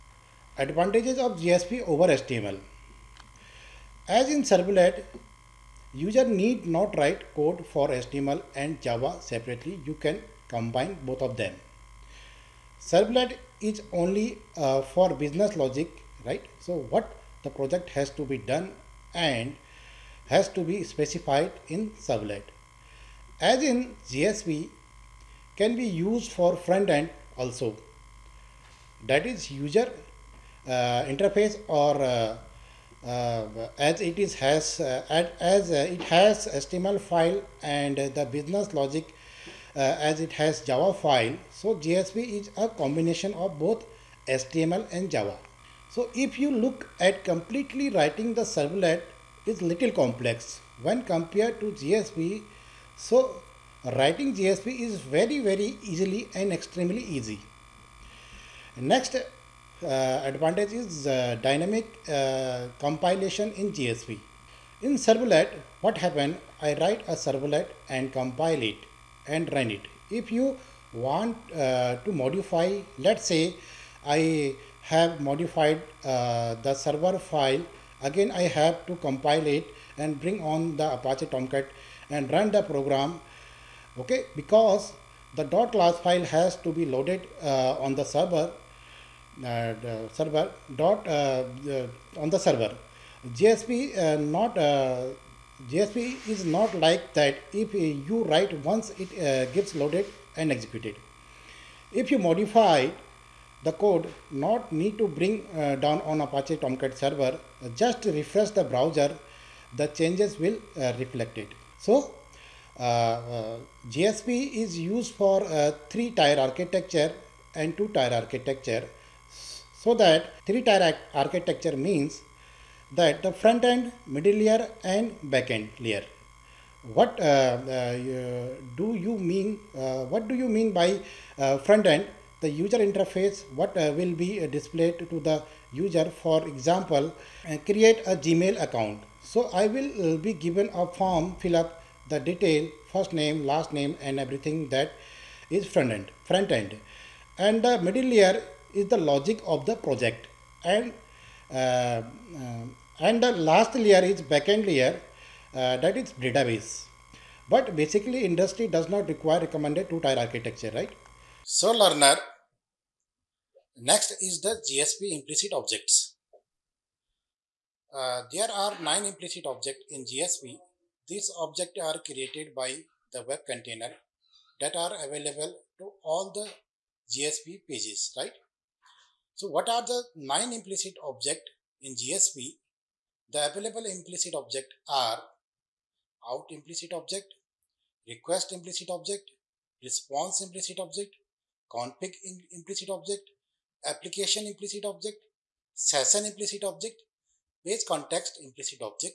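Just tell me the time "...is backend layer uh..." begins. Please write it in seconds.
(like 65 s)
154 s.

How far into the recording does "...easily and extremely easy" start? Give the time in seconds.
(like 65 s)
55 s.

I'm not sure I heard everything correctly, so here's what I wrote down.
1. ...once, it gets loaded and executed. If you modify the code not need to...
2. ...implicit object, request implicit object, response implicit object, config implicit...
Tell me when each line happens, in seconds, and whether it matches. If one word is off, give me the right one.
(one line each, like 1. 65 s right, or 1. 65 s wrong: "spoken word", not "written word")
1. 98 s right
2. 186 s right.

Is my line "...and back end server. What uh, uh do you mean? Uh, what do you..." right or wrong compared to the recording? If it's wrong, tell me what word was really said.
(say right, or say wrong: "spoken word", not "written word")
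wrong: "layer", not "server".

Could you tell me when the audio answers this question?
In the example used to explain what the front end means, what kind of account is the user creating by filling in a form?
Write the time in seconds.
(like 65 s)
138 s.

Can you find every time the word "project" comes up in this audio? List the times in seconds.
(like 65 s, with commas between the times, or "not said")
17 s, 149 s.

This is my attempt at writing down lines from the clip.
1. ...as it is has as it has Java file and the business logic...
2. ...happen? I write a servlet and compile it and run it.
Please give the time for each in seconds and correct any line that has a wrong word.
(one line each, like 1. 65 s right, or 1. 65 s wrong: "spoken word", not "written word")
1. 33 s wrong: "HTML", not "Java"
2. 65 s right.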